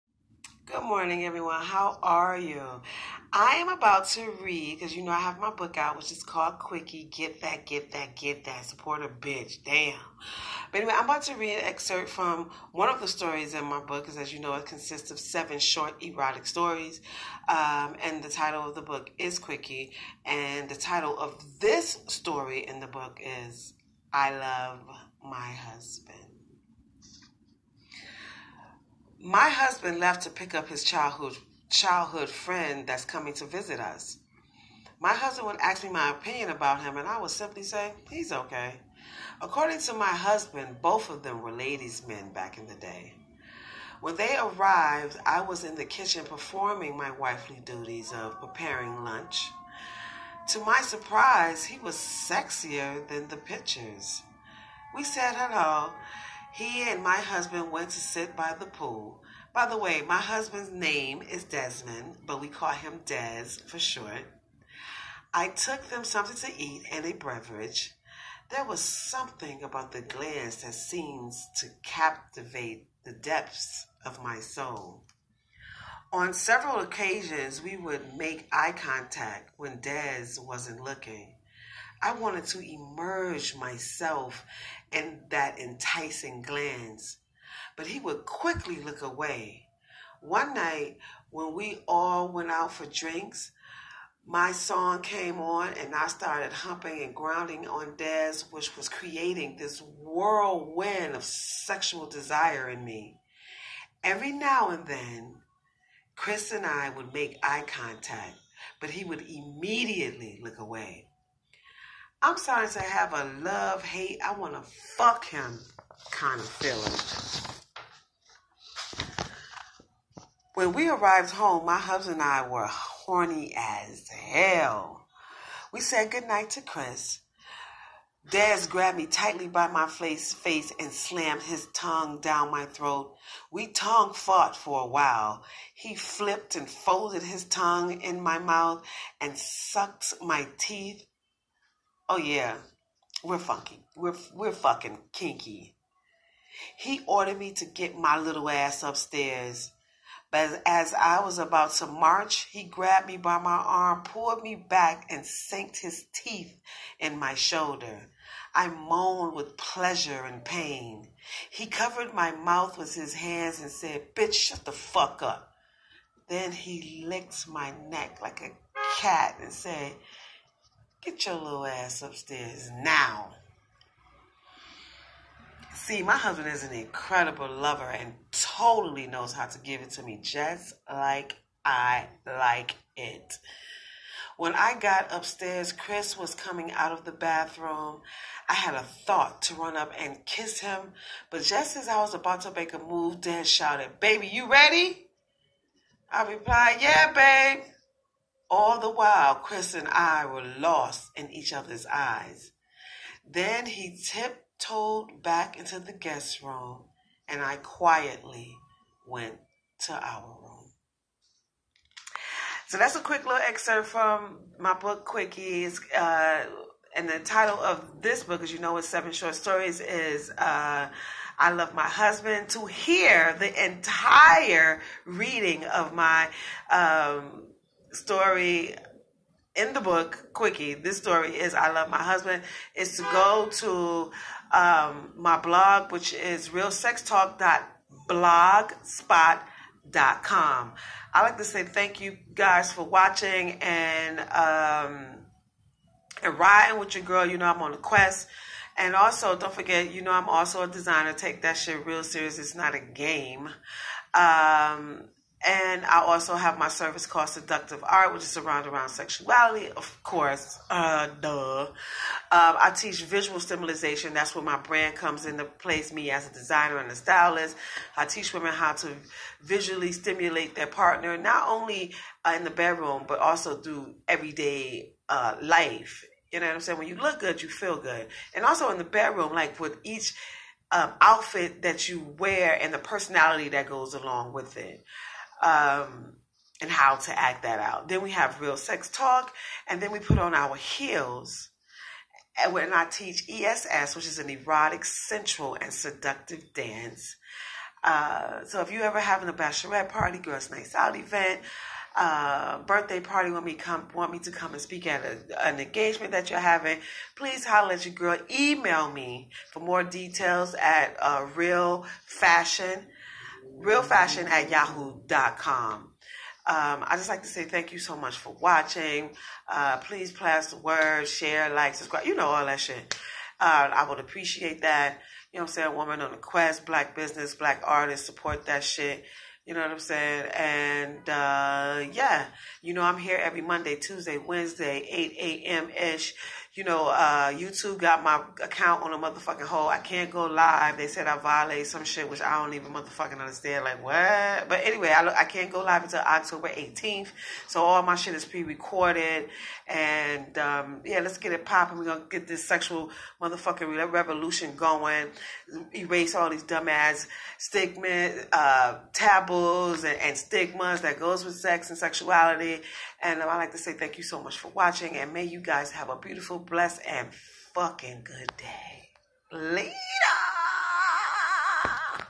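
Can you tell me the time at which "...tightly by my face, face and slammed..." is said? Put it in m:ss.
2:09.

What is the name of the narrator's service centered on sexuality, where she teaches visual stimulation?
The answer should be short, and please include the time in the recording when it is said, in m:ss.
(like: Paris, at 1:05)
Seductive Art, at 4:17.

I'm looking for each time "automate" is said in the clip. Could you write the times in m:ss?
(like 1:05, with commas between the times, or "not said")
not said.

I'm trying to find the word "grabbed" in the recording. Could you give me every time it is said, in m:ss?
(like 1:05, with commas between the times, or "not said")
2:08, 2:32.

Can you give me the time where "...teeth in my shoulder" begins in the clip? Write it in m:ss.
2:36.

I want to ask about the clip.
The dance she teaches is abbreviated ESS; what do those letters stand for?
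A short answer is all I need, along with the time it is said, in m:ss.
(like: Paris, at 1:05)
Erotic, sensual, and seductive, at 4:54.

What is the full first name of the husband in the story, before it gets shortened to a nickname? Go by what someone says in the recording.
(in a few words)
Desmond.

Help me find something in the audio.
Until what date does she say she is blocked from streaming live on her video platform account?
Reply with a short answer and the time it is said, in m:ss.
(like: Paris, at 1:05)
October 18th, at 5:46.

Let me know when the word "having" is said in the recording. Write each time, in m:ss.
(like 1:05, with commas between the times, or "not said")
4:58, 5:06.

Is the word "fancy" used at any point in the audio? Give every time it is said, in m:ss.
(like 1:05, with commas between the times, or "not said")
not said.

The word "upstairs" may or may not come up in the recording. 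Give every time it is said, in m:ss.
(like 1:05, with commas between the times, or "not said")
2:28, 2:52, 3:05.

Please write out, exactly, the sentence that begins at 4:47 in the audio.
Then we have real sex talk, and then we put on our heels.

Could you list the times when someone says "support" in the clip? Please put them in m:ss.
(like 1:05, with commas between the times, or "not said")
0:08, 5:28.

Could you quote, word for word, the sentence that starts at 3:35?
Uh, and the title of this book, as you know, is Seven Short Stories, is uh, I Love My Husband.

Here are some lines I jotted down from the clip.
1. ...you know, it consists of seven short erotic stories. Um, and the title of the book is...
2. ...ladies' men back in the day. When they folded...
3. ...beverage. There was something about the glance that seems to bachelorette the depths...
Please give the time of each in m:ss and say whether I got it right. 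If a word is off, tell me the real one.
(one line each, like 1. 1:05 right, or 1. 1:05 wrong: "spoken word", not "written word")
1. 0:14 right
2. 0:41 wrong: "arrived", not "folded"
3. 1:07 wrong: "captivate", not "bachelorette".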